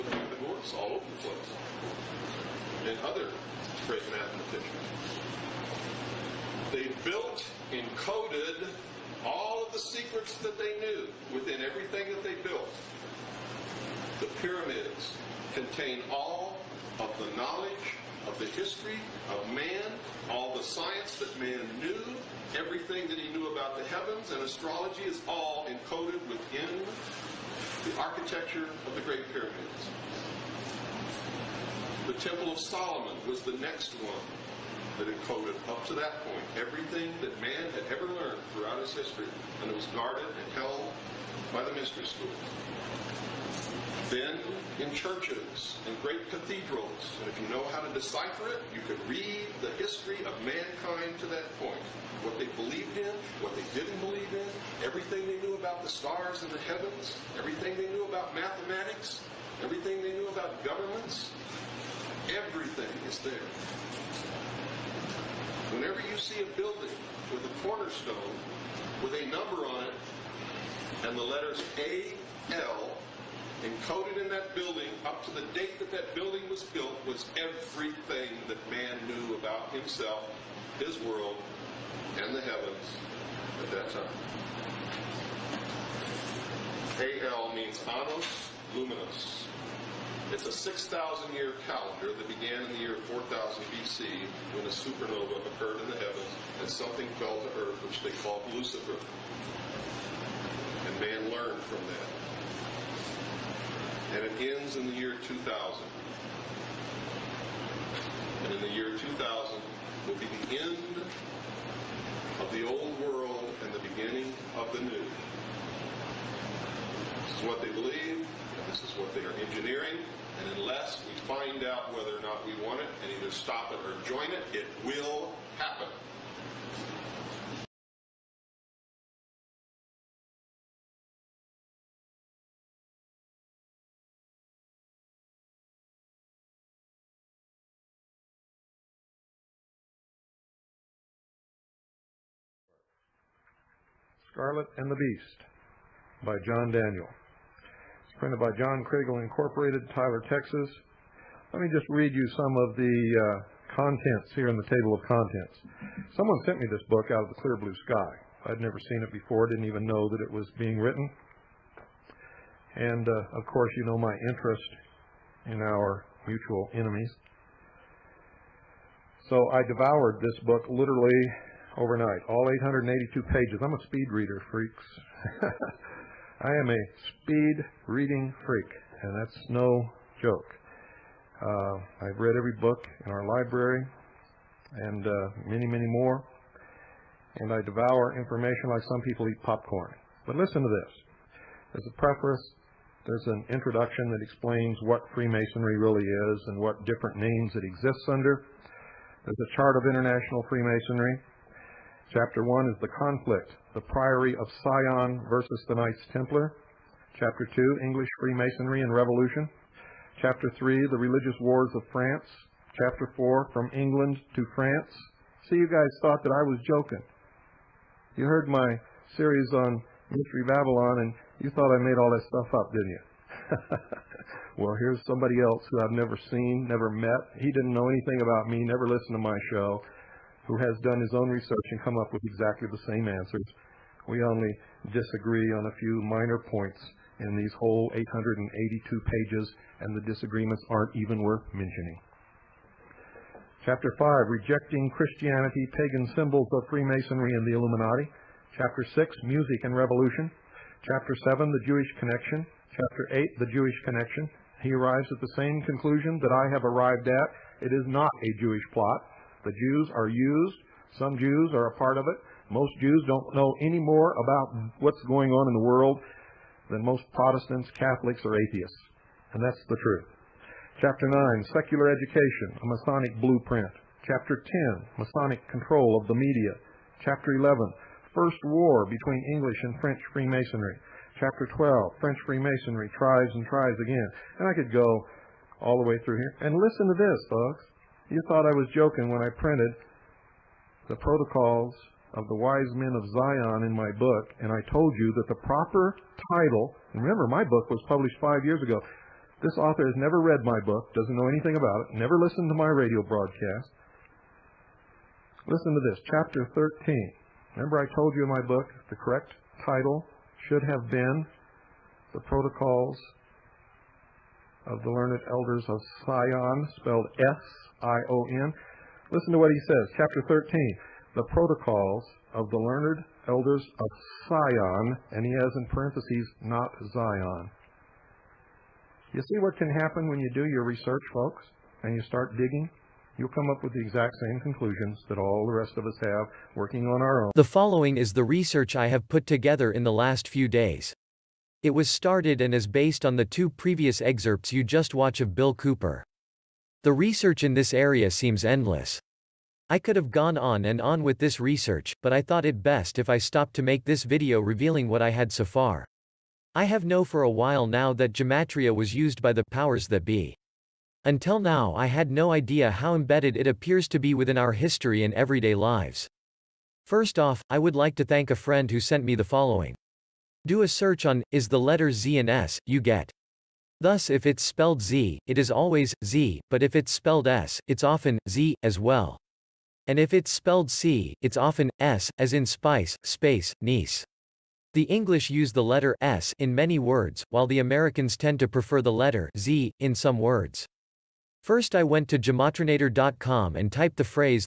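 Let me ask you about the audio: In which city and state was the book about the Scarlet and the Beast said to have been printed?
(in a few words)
Tyler, Texas.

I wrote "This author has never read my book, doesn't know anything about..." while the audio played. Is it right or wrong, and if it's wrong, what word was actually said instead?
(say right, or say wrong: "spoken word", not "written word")
right.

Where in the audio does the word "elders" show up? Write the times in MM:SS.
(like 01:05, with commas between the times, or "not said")
05:15, 05:23.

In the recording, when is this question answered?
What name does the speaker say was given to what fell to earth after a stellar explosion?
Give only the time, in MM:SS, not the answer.
01:38.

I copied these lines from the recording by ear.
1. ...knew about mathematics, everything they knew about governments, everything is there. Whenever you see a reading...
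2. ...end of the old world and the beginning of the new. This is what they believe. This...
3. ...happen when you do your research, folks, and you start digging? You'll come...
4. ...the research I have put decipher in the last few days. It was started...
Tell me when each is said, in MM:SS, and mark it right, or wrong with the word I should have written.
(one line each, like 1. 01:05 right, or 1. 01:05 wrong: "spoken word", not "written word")
1. 00:57 wrong: "building", not "reading"
2. 01:50 right
3. 05:29 right
4. 05:38 wrong: "together", not "decipher".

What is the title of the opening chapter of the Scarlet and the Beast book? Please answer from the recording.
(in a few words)
The Priory of Sion.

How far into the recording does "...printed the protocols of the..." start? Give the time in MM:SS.
04:49.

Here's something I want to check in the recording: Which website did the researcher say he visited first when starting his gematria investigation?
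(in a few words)
gematrinator.com.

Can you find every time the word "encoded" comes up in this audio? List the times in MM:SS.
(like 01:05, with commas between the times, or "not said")
00:07, 00:25, 00:35, 01:13.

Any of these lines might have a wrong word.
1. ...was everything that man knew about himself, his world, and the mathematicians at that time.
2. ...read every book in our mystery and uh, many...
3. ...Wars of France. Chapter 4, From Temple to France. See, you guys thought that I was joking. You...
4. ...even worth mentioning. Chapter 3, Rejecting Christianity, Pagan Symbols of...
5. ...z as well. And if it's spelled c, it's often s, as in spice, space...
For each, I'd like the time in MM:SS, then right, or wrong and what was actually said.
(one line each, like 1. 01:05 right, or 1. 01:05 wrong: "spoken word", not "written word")
1. 01:17 wrong: "heavens", not "mathematicians"
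2. 03:02 wrong: "library", not "mystery"
3. 03:31 wrong: "England", not "Temple"
4. 04:00 wrong: "5", not "3"
5. 06:18 right.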